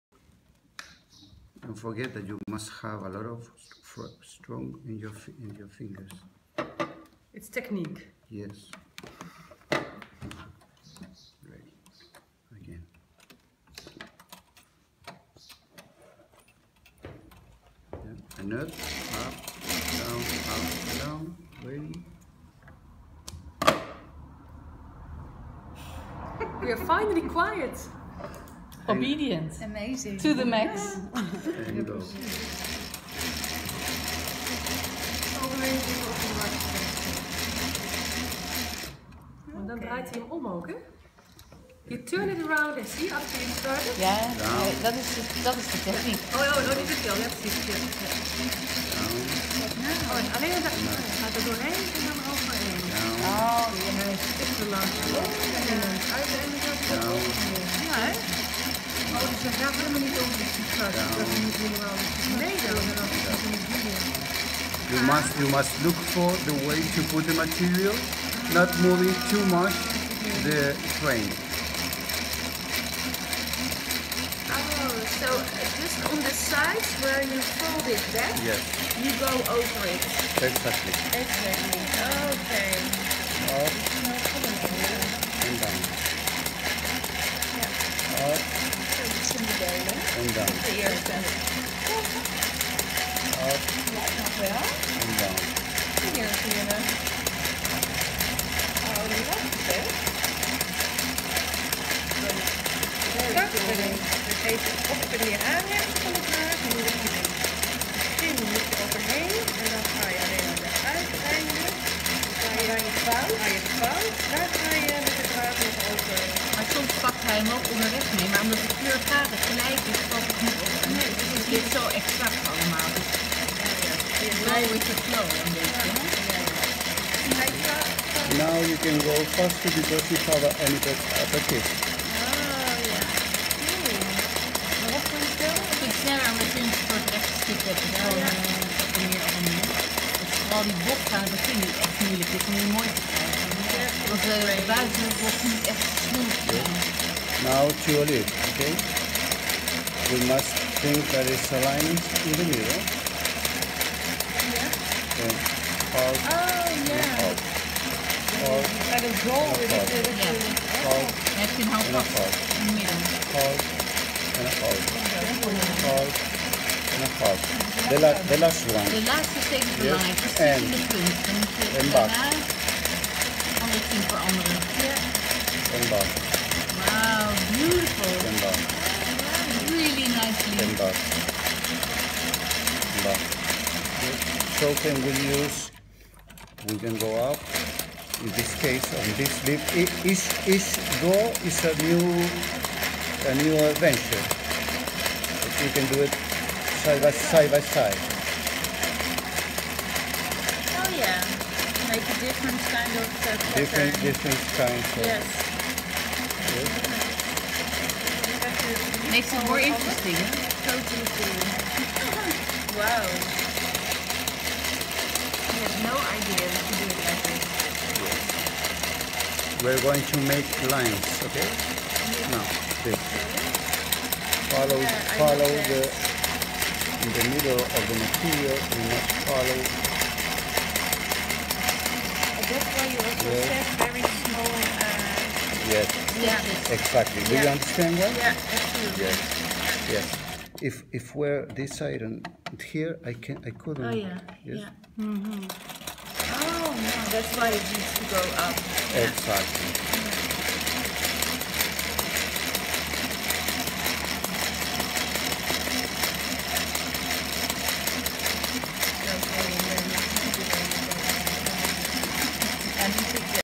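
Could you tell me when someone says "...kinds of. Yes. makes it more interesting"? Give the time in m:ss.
3:24.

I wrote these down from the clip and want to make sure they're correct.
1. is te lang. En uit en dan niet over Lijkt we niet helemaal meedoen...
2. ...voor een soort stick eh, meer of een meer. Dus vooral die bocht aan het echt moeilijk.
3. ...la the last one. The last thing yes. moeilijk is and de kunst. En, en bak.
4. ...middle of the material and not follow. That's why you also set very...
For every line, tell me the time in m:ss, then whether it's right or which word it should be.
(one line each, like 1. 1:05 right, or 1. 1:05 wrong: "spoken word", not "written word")
1. 0:54 wrong: "Dat", not "Lijkt"
2. 2:16 right
3. 2:48 wrong: "belangrijk", not "moeilijk"
4. 3:47 right.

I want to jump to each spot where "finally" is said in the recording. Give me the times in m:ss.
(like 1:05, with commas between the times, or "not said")
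0:26.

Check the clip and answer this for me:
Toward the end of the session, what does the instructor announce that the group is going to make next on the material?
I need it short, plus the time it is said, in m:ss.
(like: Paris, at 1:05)
Lines, at 3:40.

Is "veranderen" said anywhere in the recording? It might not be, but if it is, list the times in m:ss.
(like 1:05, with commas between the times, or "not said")
2:54.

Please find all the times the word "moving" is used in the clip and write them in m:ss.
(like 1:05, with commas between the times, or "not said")
1:08.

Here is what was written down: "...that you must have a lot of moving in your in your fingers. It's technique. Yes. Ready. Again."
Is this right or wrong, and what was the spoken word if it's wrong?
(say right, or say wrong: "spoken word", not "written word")
wrong: "strong", not "moving".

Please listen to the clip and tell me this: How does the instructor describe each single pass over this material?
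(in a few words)
A new adventure.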